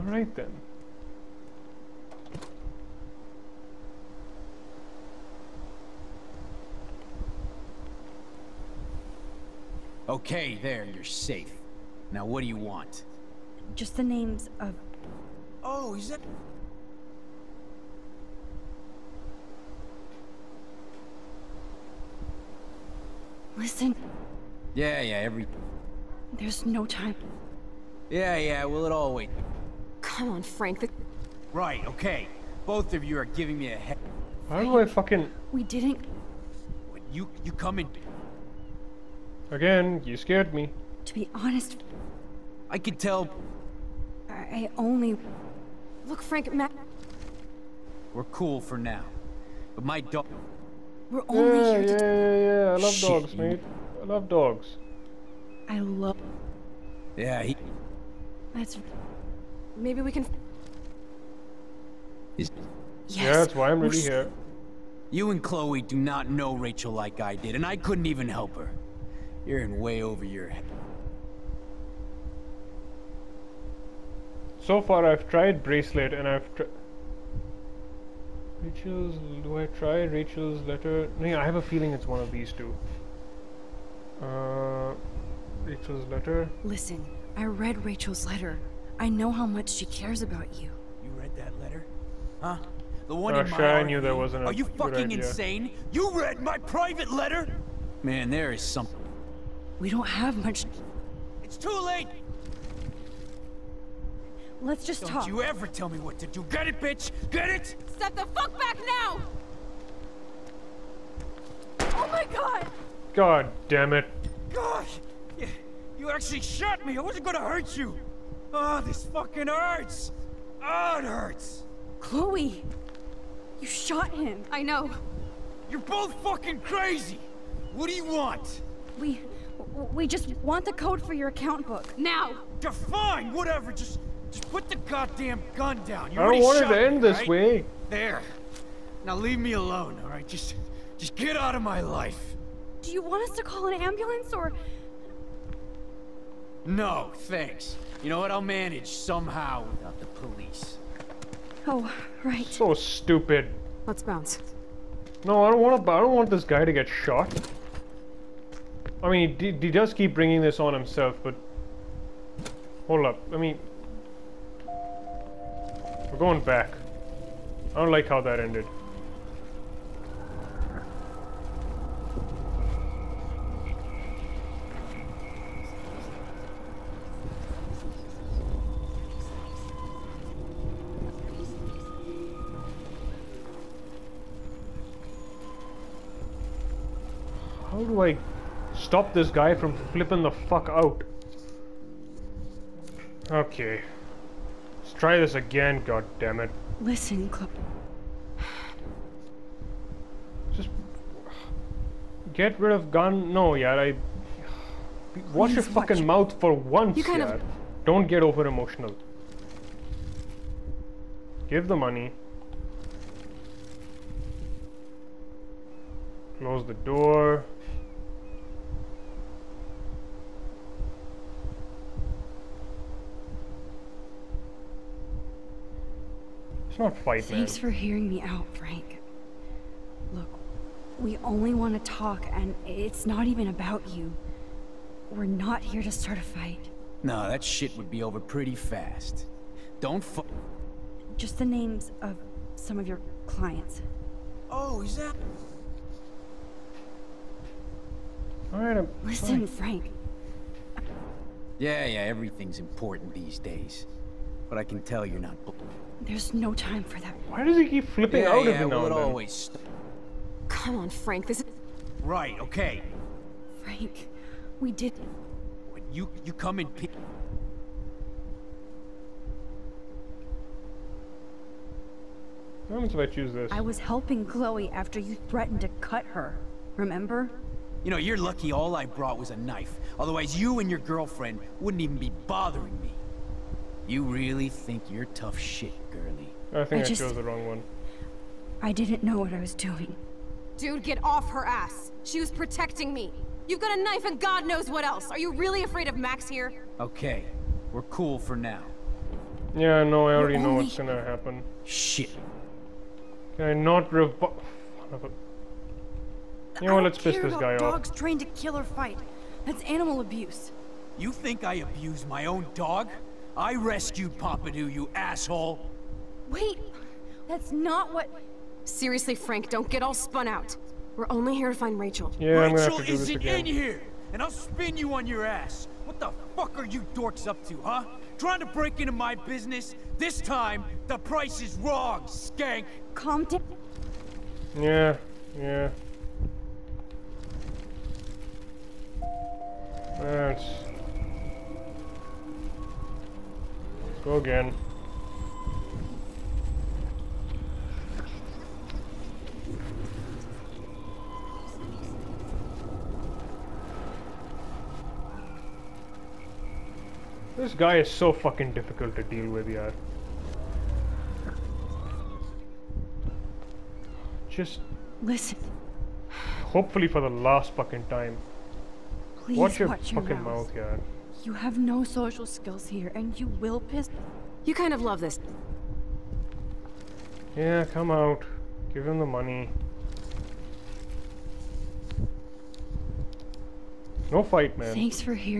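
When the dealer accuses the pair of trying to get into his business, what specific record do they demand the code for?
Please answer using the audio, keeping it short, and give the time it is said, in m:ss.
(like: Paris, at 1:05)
account book, at 2:11.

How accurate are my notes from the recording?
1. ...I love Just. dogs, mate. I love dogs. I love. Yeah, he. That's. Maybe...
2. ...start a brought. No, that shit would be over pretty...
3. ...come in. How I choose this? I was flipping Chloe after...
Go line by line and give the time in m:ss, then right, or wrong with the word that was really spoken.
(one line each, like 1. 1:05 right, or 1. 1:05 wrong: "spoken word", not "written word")
1. 0:52 wrong: "Shit", not "Just"
2. 3:55 wrong: "fight", not "brought"
3. 4:26 wrong: "helping", not "flipping".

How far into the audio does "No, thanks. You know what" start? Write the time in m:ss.
2:26.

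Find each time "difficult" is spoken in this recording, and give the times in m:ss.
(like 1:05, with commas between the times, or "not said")
5:58.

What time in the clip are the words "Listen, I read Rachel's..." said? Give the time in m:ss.
1:26.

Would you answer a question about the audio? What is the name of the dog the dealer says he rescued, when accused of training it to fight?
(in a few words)
Pompidou.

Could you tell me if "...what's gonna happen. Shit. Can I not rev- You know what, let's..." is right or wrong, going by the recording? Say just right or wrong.
right.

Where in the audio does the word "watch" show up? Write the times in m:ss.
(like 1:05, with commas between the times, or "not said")
3:25, 6:09.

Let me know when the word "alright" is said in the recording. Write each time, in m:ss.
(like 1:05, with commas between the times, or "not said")
2:20, 4:08.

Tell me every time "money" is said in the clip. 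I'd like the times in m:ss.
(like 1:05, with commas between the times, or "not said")
3:31, 6:19.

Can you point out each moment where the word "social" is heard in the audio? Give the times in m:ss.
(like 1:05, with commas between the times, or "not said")
6:11.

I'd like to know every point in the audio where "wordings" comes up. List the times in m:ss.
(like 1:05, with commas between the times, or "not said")
not said.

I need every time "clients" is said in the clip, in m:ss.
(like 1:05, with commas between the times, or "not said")
4:03.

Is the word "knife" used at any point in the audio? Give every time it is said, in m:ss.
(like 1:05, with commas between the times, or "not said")
4:39, 4:53.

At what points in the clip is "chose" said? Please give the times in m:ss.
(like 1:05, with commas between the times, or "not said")
4:47.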